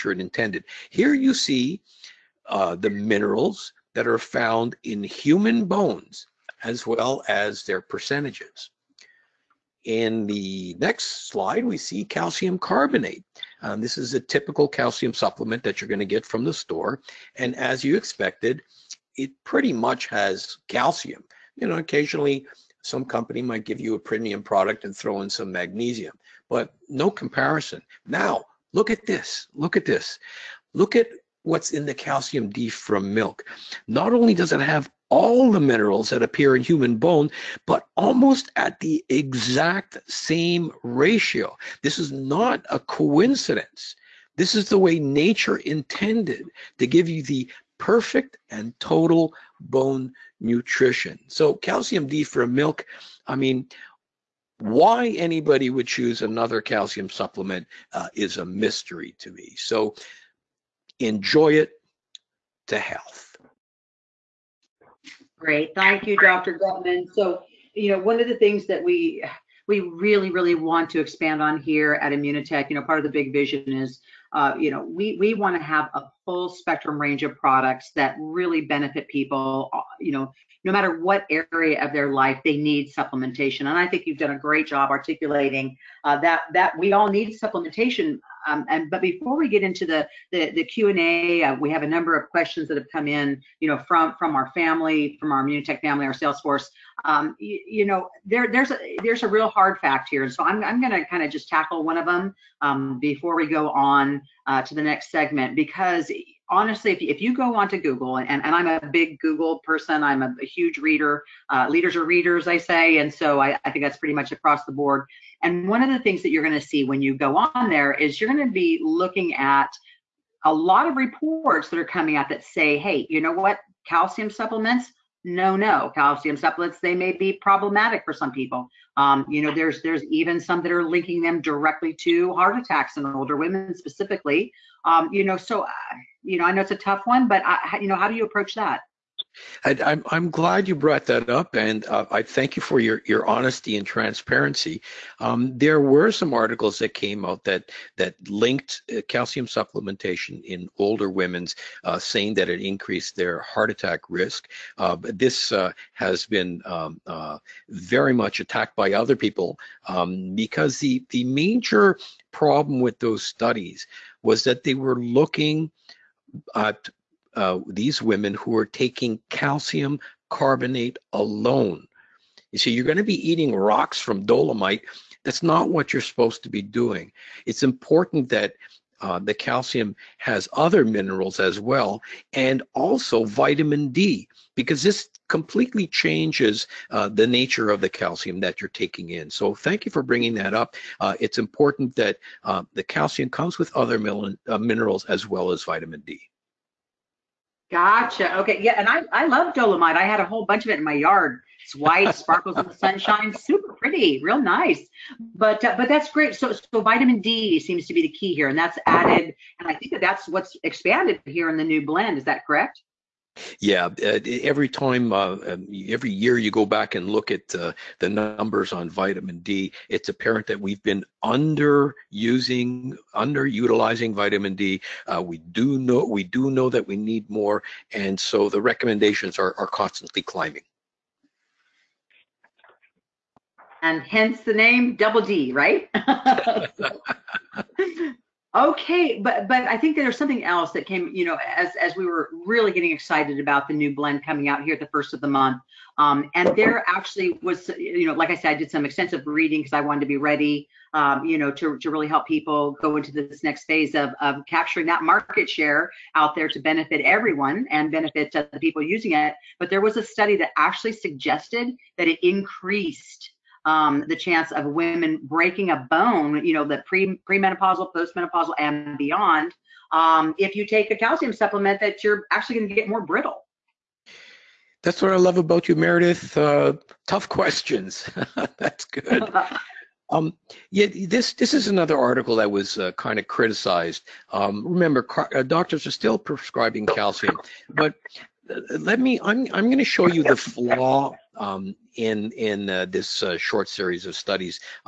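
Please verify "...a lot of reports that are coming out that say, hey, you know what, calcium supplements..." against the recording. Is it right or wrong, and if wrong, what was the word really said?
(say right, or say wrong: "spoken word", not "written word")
right.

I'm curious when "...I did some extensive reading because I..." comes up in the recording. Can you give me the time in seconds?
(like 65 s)
248 s.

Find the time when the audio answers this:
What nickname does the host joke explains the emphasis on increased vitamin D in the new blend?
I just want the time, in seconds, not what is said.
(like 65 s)
234 s.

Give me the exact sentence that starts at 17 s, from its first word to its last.
And as you expected, it pretty much has calcium.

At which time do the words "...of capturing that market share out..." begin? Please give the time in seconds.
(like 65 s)
254 s.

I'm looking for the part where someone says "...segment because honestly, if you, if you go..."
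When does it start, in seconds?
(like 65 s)
105 s.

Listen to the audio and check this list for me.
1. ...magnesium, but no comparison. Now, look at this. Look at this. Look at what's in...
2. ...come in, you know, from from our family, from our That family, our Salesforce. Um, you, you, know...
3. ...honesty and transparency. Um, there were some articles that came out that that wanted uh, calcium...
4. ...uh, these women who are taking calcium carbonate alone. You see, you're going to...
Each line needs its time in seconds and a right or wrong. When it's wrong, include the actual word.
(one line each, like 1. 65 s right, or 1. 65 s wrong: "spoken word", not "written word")
1. 25 s right
2. 92 s wrong: "Immunotec", not "That"
3. 143 s wrong: "linked", not "wanted"
4. 167 s right.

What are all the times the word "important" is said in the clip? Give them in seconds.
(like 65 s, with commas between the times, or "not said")
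177 s, 191 s.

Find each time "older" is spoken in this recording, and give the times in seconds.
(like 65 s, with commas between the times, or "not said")
133 s, 150 s.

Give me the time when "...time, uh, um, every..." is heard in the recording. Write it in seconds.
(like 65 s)
214 s.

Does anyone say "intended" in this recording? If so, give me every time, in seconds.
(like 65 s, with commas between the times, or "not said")
0 s, 45 s.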